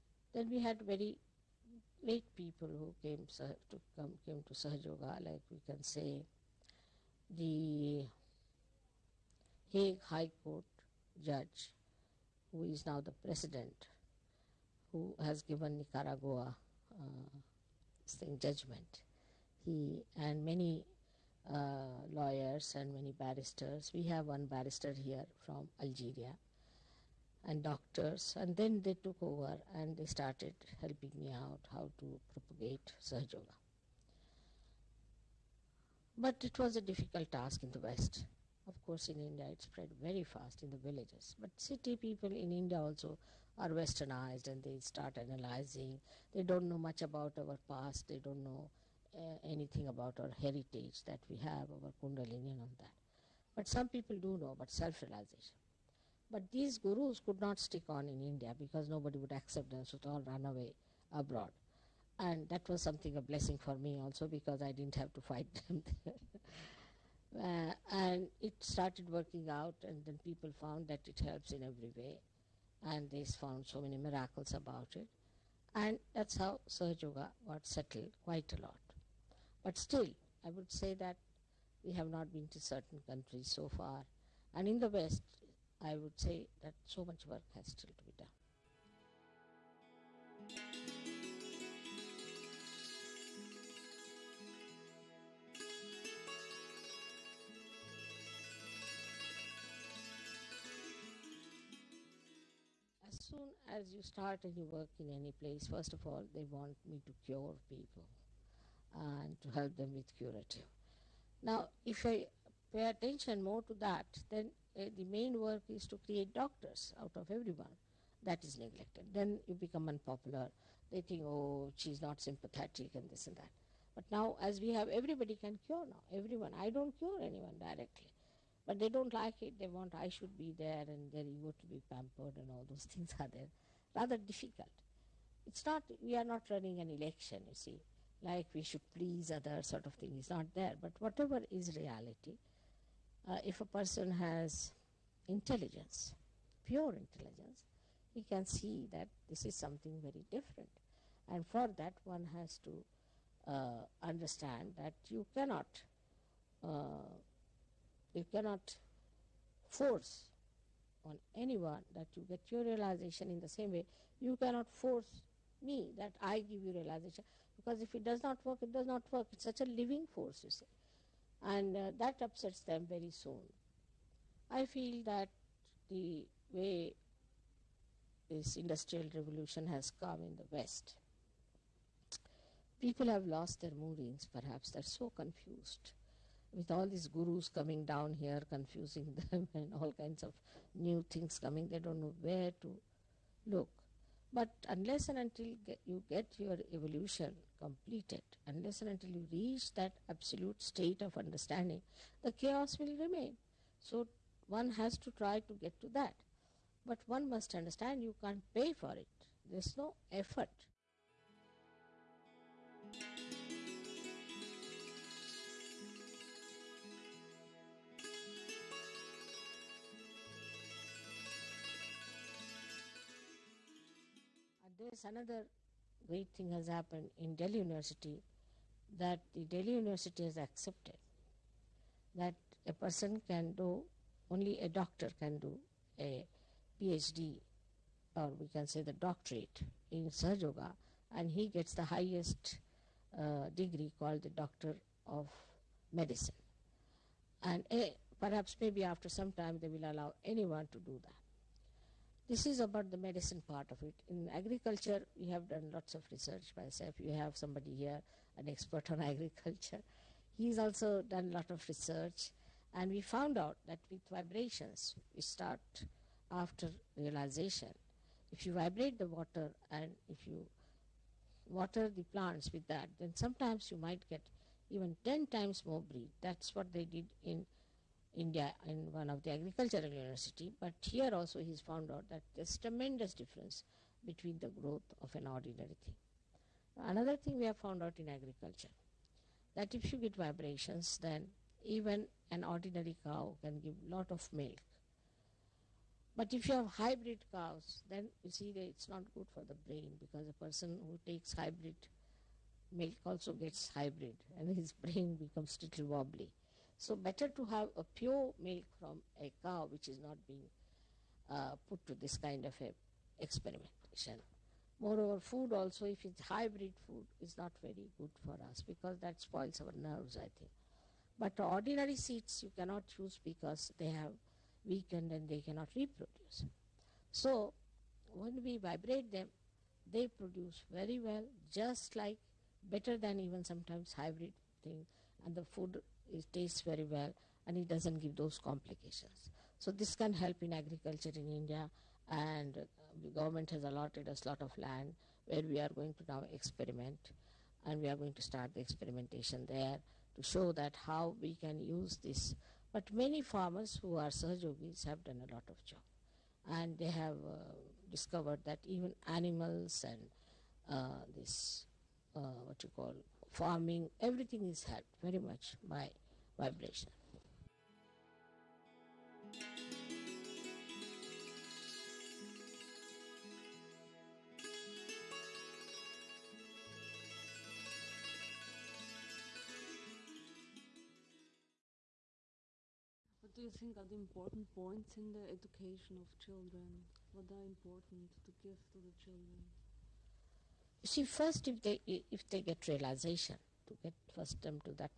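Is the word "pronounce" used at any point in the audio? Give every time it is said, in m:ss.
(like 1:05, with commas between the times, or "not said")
not said.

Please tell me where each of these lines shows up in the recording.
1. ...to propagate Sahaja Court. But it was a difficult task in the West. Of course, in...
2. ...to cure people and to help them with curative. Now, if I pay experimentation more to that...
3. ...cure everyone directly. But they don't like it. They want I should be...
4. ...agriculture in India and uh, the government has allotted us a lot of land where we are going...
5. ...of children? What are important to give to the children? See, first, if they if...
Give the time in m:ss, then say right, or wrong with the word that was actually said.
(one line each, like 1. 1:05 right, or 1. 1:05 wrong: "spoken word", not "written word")
1. 0:31 wrong: "Yoga", not "Court"
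2. 1:47 wrong: "attention", not "experimentation"
3. 2:06 wrong: "anyone", not "everyone"
4. 5:40 right
5. 6:25 right.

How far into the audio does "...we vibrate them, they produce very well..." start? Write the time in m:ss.
5:28.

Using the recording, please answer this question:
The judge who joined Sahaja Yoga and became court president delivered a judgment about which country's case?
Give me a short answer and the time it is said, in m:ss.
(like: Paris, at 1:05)
Nicaragua, at 0:15.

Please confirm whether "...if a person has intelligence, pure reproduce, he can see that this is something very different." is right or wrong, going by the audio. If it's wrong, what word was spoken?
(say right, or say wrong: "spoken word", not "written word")
wrong: "intelligence", not "reproduce".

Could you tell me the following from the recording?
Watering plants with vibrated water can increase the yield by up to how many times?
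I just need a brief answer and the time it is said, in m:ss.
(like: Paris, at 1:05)
10, at 4:35.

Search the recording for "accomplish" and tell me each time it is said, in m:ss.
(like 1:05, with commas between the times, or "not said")
not said.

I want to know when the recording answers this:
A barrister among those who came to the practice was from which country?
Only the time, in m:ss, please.
0:25.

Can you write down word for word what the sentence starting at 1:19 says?
But still, I would say that we have not been to certain countries so far.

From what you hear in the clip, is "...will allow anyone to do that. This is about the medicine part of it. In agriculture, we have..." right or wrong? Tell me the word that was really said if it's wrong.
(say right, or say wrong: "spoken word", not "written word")
right.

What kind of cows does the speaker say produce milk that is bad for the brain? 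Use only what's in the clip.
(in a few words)
Hybrid cows.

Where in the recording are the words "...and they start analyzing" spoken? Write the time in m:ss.
0:44.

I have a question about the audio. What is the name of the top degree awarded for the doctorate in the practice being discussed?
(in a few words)
Doctor of Medicine.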